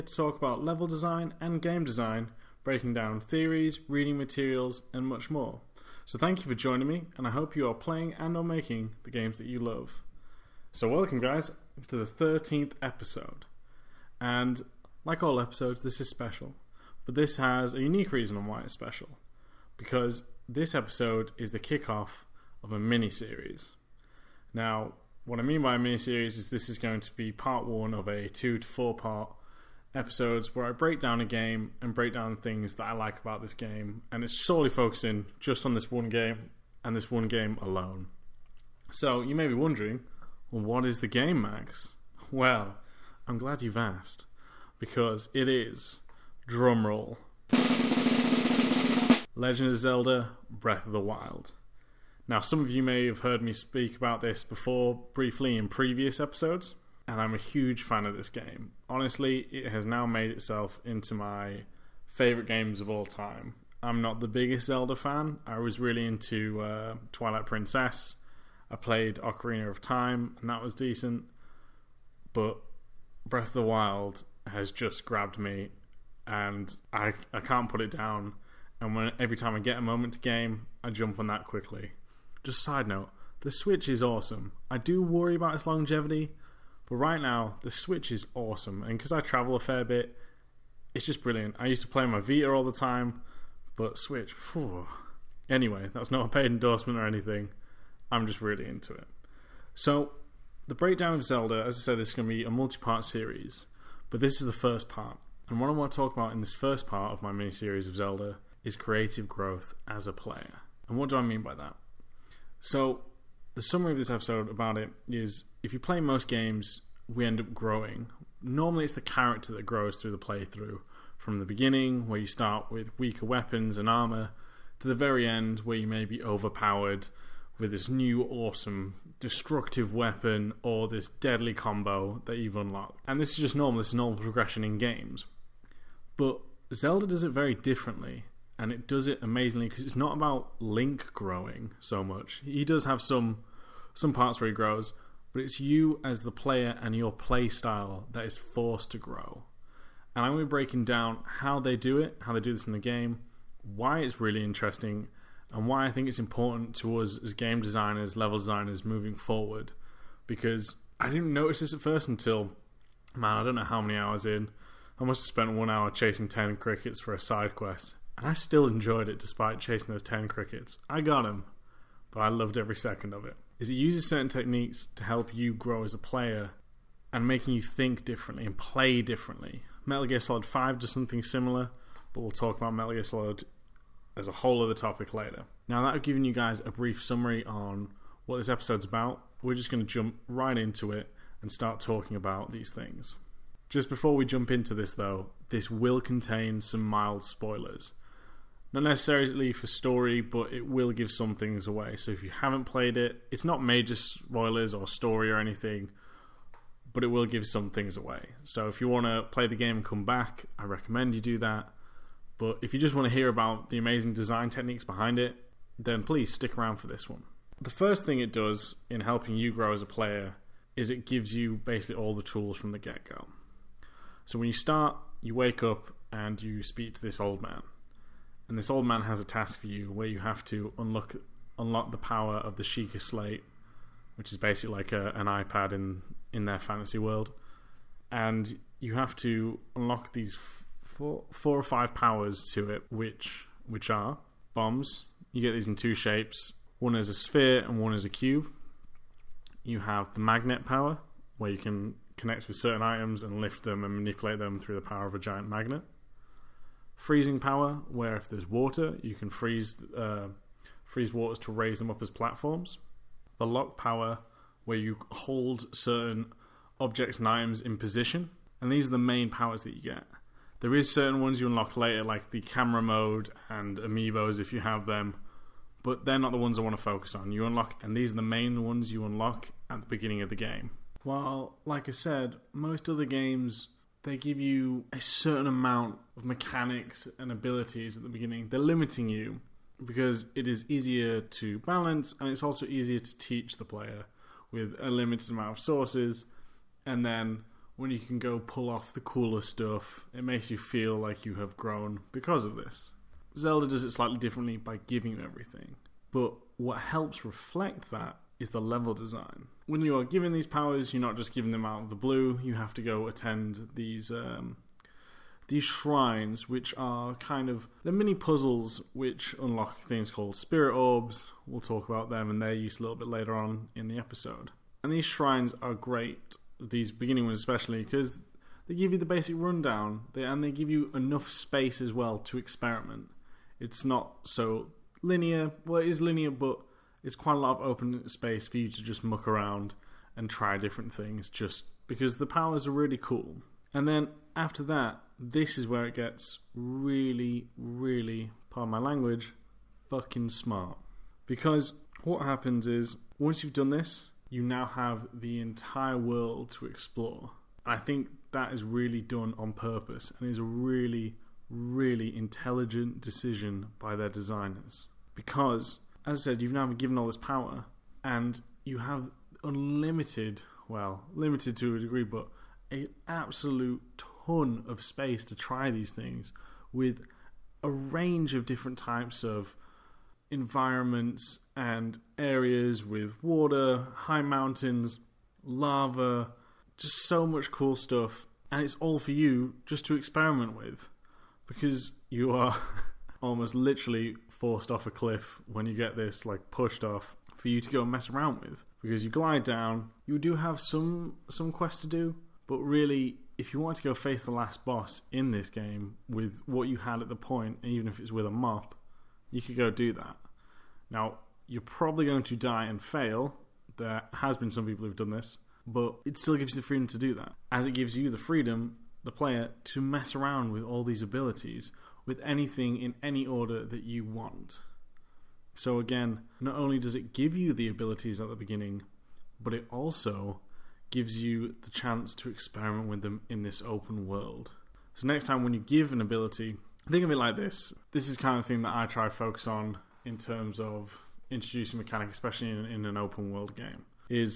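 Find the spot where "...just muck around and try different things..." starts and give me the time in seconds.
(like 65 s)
338 s.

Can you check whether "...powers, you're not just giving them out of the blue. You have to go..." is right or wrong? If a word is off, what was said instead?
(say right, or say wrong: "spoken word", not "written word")
right.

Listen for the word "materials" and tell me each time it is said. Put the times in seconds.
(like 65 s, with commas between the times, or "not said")
4 s.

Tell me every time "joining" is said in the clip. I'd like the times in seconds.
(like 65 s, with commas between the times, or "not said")
6 s.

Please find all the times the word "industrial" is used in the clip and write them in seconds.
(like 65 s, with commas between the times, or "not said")
not said.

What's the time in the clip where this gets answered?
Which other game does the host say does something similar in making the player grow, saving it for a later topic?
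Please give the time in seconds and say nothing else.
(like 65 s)
179 s.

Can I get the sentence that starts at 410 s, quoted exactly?
Now, you're probably going to die and fail.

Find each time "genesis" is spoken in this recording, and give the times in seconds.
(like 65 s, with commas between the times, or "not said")
not said.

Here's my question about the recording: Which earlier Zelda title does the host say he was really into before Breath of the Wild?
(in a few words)
Twilight Princess.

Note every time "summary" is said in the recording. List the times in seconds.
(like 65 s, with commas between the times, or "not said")
113 s, 187 s.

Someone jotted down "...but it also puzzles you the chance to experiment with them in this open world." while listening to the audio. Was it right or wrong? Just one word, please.
wrong.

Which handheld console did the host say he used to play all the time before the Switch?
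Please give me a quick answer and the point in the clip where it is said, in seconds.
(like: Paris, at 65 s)
Vita, at 92 s.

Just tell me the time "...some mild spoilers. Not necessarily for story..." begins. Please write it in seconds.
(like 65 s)
196 s.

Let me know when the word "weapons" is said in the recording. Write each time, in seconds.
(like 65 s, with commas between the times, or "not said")
123 s, 129 s.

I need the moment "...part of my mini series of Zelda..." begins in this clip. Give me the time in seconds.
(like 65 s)
106 s.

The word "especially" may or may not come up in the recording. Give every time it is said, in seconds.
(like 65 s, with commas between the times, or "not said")
327 s, 442 s.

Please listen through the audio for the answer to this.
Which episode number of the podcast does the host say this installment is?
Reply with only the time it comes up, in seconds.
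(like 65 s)
12 s.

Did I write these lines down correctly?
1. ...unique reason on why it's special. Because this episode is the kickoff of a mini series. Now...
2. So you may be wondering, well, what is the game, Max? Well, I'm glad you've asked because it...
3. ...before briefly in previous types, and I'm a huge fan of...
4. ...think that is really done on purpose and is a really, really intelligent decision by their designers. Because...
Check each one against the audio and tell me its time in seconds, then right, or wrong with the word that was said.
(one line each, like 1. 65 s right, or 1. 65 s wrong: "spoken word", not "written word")
1. 17 s right
2. 38 s right
3. 54 s wrong: "episodes", not "types"
4. 357 s right.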